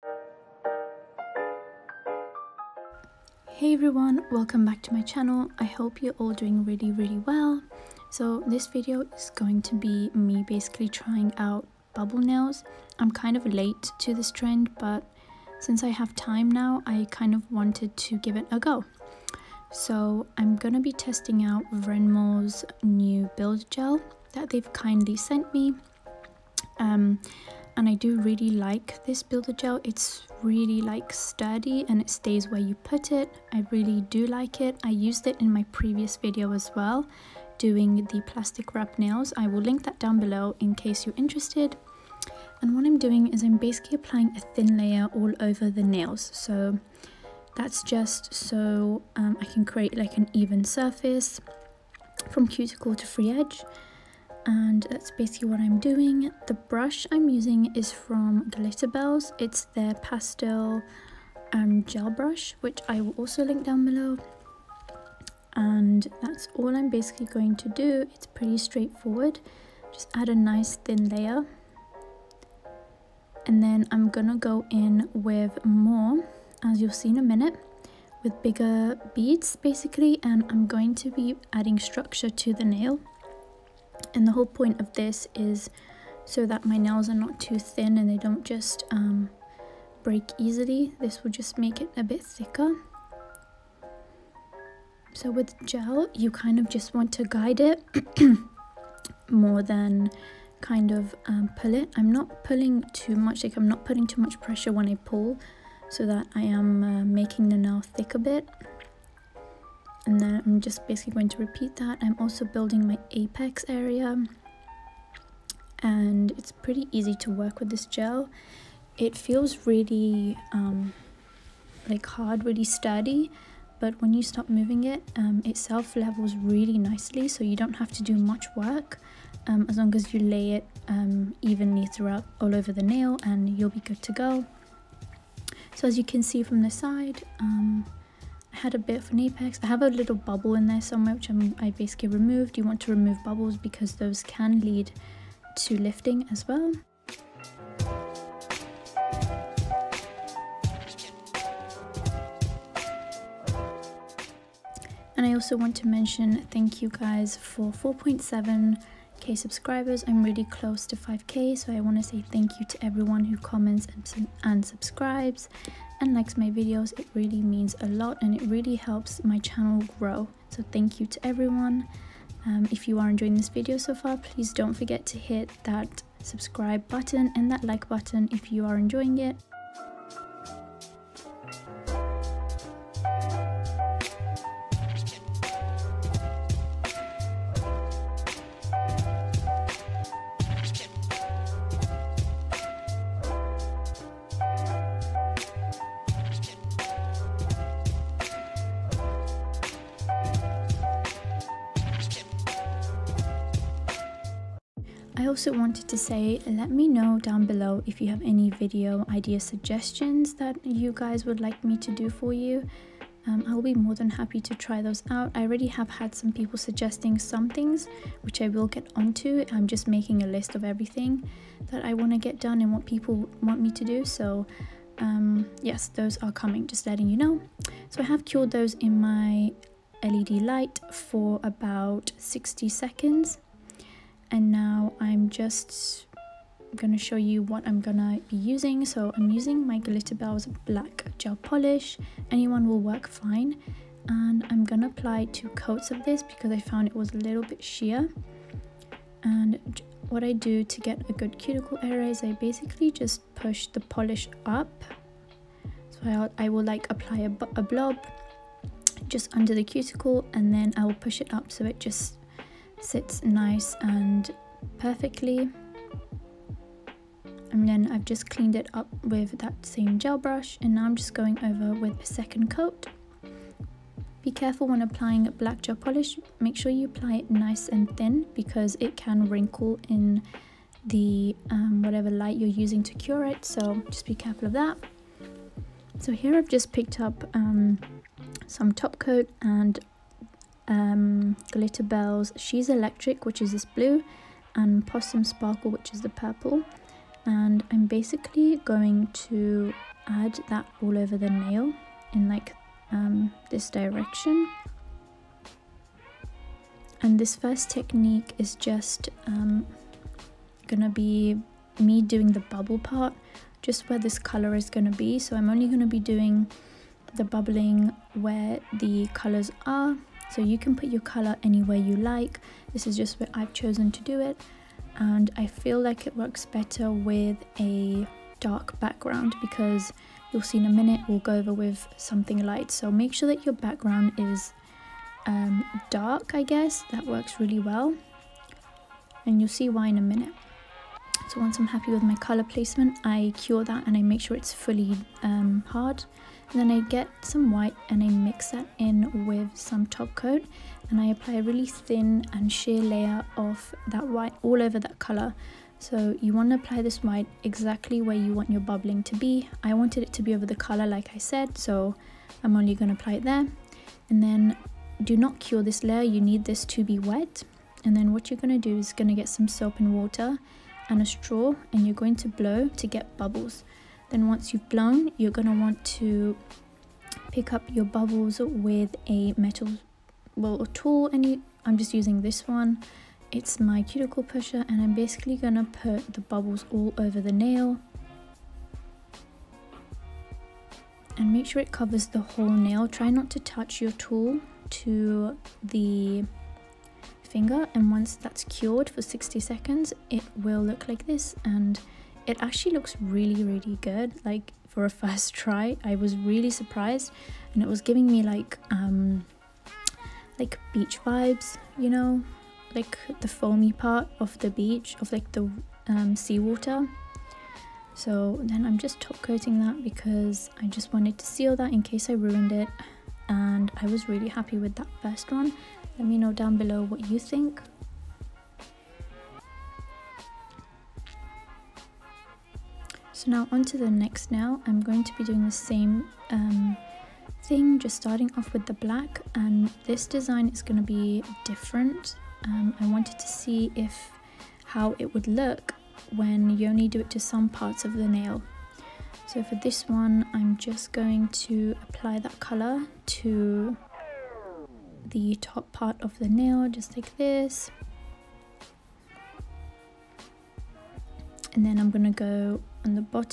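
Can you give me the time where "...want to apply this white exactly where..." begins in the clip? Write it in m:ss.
5:56.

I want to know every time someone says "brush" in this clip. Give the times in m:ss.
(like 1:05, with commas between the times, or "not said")
0:56, 1:02, 4:30.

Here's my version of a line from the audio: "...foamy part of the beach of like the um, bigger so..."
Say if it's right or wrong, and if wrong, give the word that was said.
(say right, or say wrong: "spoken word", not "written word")
wrong: "seawater", not "bigger".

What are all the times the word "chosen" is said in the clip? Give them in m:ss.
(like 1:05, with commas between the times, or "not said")
5:23.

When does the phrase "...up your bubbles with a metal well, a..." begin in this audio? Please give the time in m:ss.
6:17.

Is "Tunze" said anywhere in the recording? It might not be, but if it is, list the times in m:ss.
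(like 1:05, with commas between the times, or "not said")
not said.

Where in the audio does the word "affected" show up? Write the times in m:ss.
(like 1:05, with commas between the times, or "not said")
not said.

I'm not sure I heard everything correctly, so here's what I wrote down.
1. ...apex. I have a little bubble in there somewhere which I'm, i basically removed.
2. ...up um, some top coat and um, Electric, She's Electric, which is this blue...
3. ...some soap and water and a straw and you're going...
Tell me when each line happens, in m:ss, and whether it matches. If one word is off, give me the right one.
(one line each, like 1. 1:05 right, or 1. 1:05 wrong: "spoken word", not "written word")
1. 2:19 right
2. 4:47 wrong: "Glitterbels", not "Electric"
3. 6:09 right.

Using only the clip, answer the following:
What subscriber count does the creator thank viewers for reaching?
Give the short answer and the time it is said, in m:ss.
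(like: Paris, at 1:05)
4.7k, at 2:37.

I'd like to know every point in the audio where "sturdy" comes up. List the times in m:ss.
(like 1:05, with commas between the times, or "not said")
0:31, 2:02.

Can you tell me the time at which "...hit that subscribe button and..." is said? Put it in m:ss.
2:55.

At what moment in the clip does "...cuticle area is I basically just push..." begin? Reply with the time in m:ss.
4:11.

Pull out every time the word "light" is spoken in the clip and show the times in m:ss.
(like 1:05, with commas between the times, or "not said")
3:50, 4:42, 5:32.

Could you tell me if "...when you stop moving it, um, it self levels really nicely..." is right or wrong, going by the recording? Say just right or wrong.
right.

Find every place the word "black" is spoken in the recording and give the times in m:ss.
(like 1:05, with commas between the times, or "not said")
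4:00, 4:35, 7:18.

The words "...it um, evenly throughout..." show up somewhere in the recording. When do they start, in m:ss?
2:10.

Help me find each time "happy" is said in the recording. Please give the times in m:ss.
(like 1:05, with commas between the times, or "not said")
3:34, 5:41, 7:04.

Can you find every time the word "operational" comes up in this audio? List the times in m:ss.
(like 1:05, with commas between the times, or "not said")
not said.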